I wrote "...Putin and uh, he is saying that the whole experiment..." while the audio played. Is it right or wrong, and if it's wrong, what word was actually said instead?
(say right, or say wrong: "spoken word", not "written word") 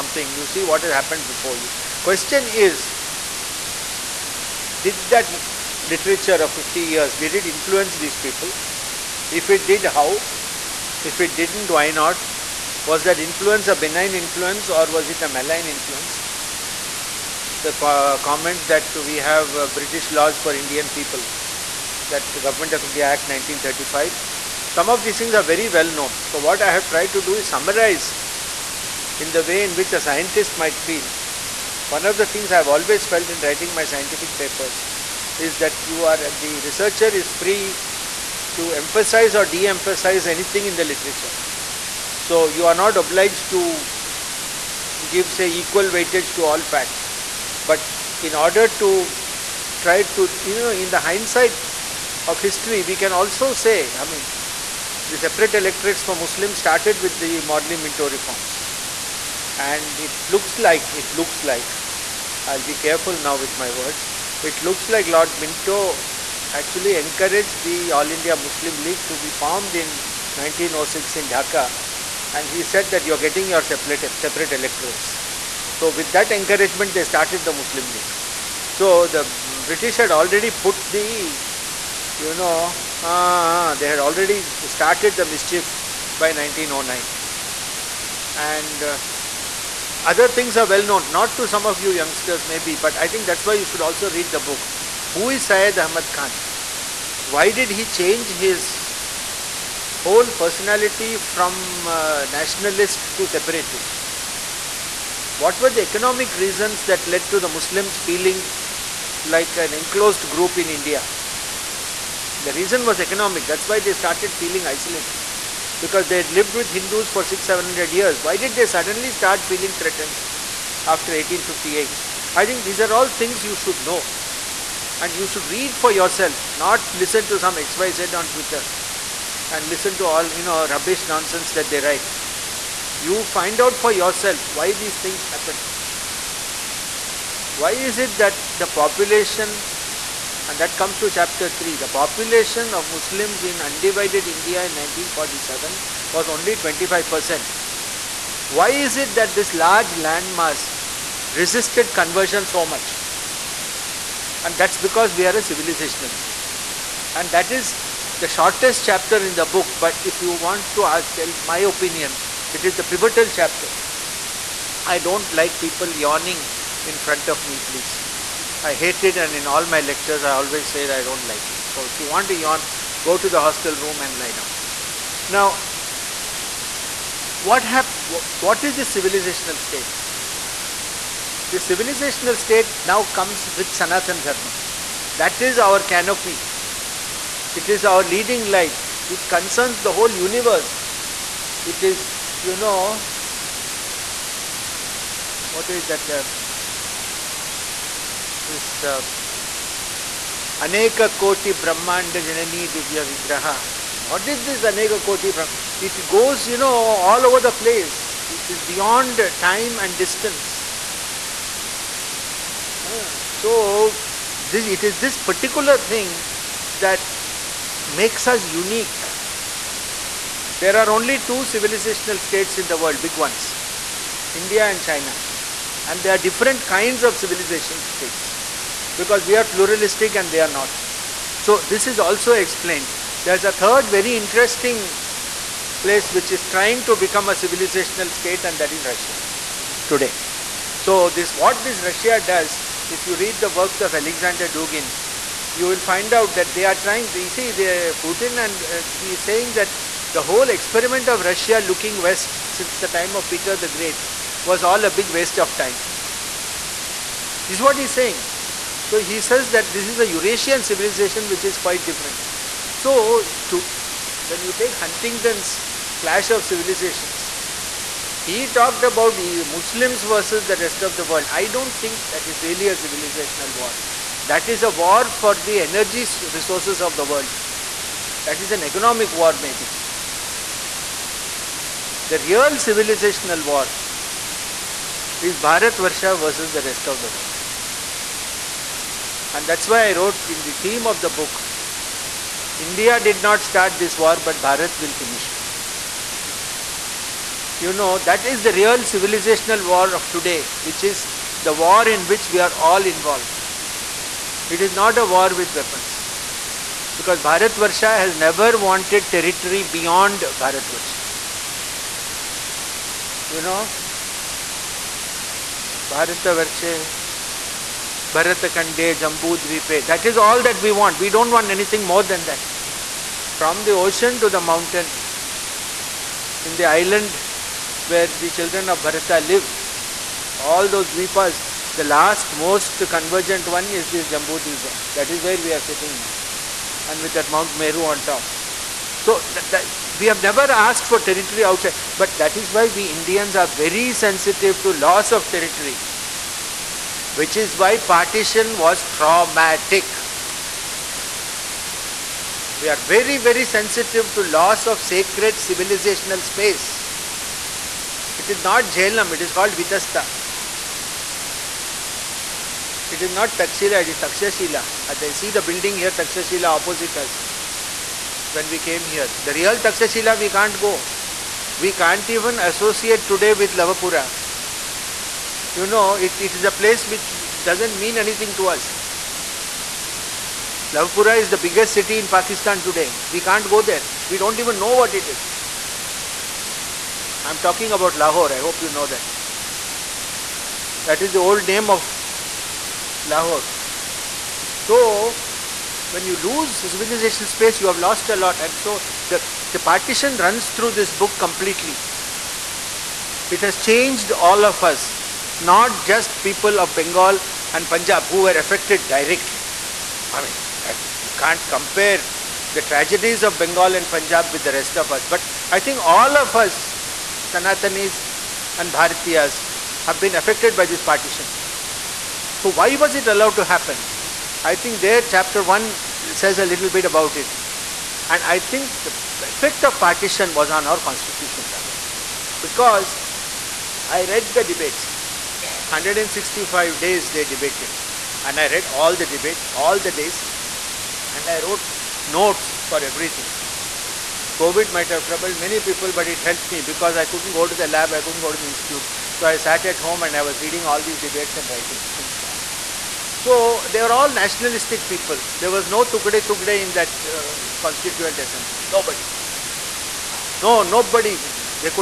right.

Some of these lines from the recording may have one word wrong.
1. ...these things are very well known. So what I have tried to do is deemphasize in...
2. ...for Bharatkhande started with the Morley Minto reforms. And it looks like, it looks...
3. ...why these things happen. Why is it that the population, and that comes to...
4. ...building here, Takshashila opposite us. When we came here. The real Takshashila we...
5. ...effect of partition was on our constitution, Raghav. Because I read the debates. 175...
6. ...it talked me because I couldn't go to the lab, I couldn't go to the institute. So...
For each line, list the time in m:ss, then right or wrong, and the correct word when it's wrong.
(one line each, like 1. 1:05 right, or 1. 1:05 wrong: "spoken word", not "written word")
1. 0:25 wrong: "summarize", not "deemphasize"
2. 0:56 wrong: "Muslims", not "Bharatkhande"
3. 2:14 right
4. 6:05 right
5. 7:09 wrong: "165", not "175"
6. 7:26 wrong: "helped", not "talked".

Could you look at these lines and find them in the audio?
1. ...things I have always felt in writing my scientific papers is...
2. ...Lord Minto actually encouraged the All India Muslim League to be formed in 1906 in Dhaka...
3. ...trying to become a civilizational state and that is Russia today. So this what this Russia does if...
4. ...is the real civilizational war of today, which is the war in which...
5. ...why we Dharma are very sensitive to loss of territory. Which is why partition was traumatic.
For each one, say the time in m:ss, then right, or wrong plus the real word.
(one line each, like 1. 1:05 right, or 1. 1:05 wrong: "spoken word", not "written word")
1. 0:32 right
2. 1:05 right
3. 3:56 right
4. 4:58 right
5. 5:42 wrong: "Indians", not "Dharma".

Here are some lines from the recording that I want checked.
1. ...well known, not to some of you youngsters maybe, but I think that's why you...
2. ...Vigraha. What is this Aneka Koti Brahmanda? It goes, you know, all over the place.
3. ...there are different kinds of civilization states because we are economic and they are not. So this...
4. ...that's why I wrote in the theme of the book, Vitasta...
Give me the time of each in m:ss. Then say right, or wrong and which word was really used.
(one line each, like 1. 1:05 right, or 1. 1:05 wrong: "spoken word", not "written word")
1. 1:30 right
2. 3:23 right
3. 3:46 wrong: "pluralistic", not "economic"
4. 4:49 wrong: "India", not "Vitasta".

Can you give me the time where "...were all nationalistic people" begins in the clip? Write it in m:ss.
7:33.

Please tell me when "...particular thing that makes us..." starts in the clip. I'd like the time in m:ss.
3:35.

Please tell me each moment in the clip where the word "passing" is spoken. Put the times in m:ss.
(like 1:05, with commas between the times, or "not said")
not said.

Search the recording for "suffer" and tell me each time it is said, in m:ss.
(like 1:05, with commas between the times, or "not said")
not said.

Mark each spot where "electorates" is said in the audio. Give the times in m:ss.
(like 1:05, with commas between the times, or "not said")
0:55, 1:14.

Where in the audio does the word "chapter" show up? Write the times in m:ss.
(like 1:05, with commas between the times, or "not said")
2:21, 2:38, 2:43, 7:05.